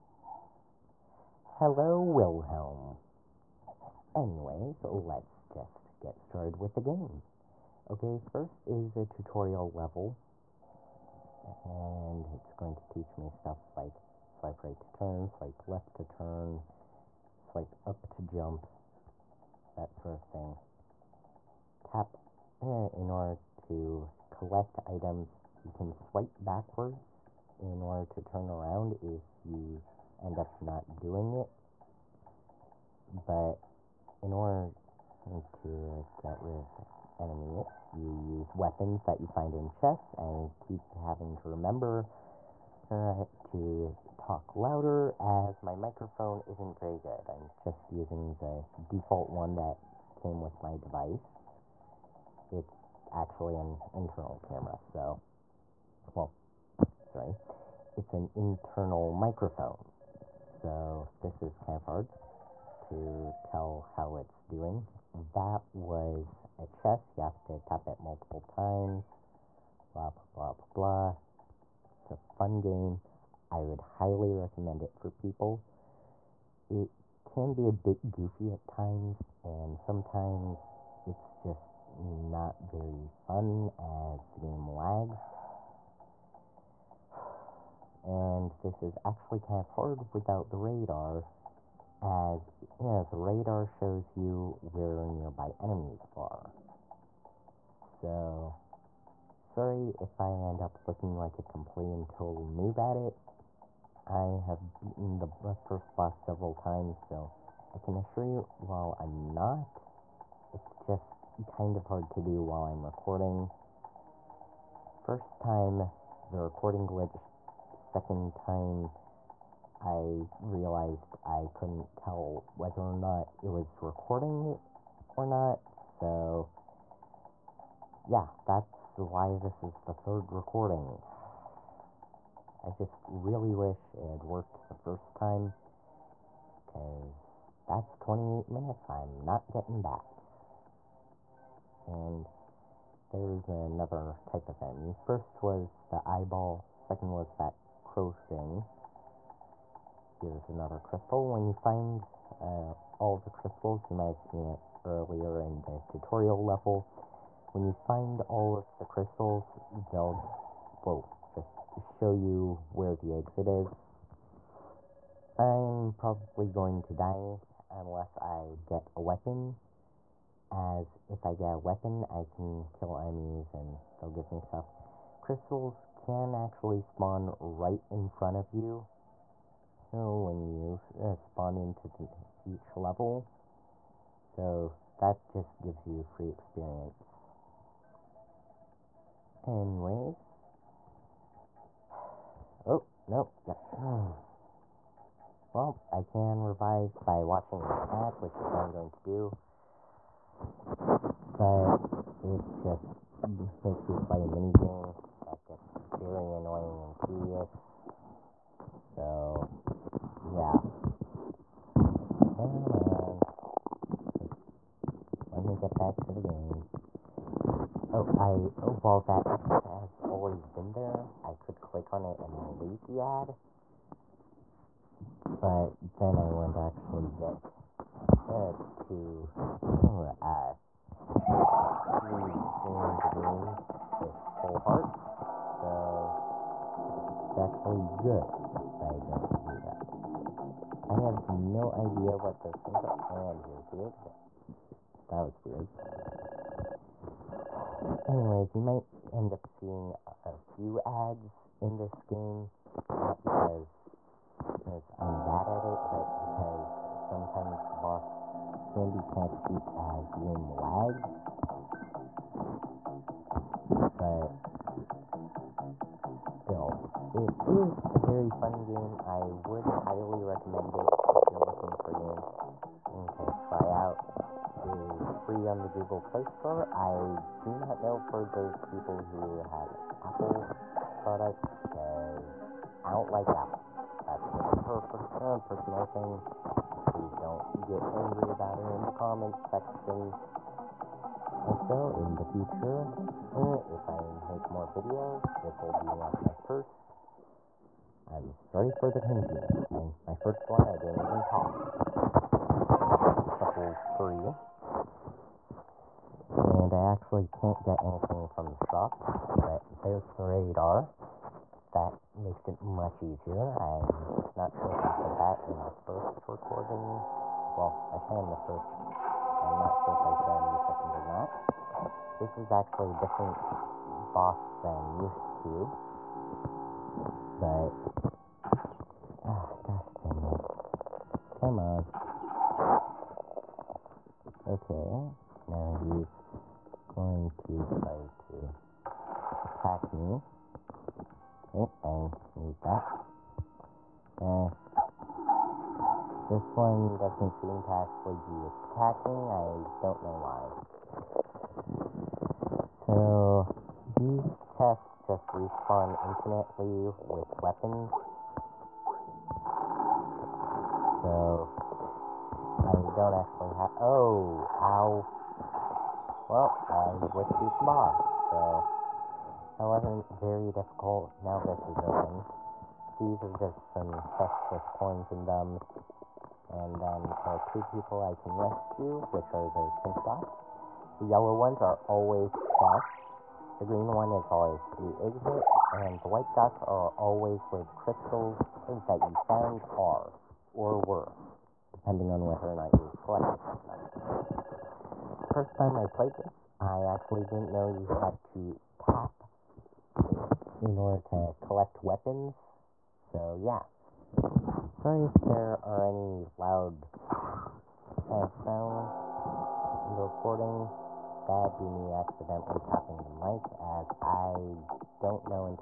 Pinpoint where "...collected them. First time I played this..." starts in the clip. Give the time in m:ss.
6:33.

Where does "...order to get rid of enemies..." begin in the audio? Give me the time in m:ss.
0:34.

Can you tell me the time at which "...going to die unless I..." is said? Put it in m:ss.
2:46.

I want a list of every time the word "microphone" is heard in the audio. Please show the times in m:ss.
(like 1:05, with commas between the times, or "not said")
0:45, 0:59.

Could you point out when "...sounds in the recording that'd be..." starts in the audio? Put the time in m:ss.
6:48.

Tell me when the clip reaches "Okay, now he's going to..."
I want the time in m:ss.
5:34.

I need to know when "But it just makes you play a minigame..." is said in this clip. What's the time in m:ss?
3:21.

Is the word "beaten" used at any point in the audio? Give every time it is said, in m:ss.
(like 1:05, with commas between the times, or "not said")
1:44.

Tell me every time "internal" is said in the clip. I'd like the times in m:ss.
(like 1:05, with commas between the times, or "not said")
0:53, 0:58.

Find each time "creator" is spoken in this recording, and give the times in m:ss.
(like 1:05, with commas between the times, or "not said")
not said.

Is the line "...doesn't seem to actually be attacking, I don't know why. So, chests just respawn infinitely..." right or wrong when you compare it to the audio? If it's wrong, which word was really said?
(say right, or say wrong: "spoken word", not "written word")
right.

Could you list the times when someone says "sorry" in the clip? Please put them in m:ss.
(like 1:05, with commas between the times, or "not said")
0:57, 1:39, 4:58, 6:44.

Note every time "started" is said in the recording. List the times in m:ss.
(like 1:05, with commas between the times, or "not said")
0:06.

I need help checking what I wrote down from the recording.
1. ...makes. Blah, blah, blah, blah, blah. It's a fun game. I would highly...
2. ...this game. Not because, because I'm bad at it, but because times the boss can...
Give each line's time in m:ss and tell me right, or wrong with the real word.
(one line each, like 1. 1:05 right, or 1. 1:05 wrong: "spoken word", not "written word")
1. 1:08 wrong: "times", not "makes"
2. 4:11 wrong: "sometimes", not "times".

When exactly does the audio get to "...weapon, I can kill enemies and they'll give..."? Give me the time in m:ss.
2:51.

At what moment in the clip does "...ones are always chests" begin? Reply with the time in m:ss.
6:21.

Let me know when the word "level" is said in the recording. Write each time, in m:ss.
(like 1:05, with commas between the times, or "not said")
0:09, 2:36, 3:02.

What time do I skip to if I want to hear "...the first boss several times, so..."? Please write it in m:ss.
1:45.